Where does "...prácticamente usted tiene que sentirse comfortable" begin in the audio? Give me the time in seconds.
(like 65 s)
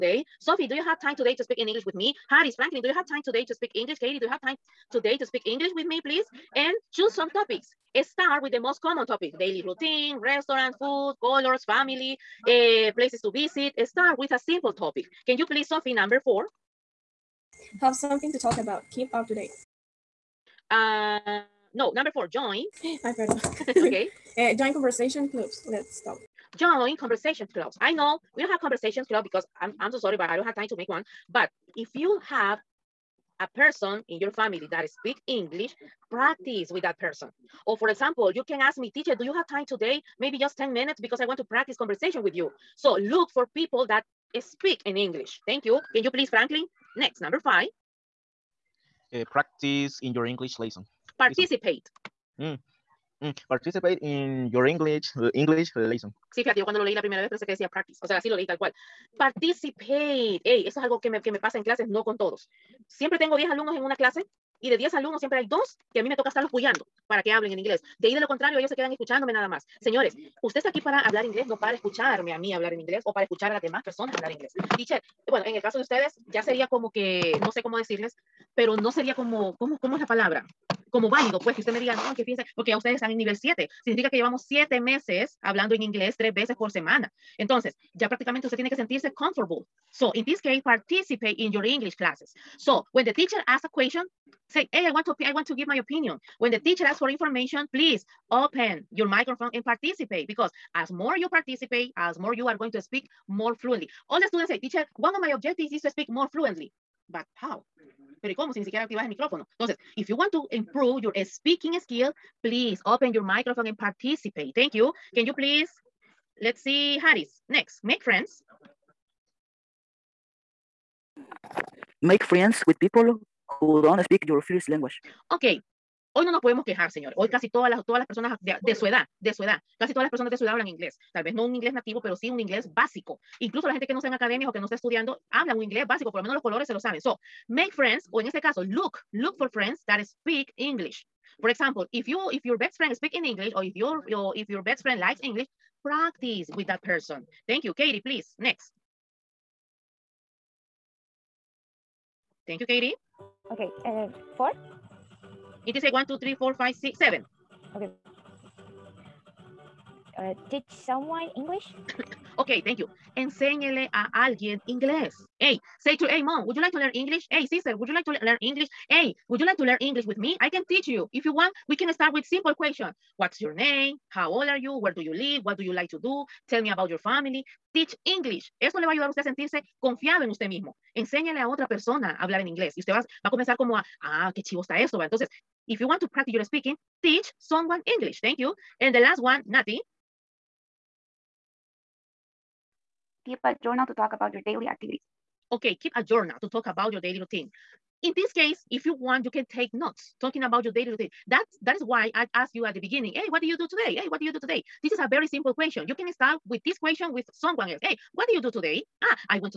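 88 s.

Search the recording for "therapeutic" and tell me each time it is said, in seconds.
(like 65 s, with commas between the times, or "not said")
not said.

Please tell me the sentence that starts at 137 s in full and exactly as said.
So, make friends, o en este caso, look Look for friends that speak English.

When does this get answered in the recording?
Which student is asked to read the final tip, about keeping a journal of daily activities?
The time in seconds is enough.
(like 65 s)
189 s.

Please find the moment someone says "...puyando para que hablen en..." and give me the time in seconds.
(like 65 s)
66 s.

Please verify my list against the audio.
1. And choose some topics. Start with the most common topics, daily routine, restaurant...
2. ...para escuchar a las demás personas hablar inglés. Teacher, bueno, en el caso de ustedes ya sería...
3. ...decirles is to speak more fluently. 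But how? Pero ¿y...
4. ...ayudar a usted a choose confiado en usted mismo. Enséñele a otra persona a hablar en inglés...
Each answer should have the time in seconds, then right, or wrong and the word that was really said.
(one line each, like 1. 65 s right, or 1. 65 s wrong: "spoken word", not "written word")
1. 6 s right
2. 73 s right
3. 105 s wrong: "objectives", not "decirles"
4. 178 s wrong: "sentirse", not "choose".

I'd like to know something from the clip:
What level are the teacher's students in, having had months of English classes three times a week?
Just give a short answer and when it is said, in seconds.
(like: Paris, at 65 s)
7, at 83 s.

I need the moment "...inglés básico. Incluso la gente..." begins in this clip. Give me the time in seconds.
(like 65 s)
132 s.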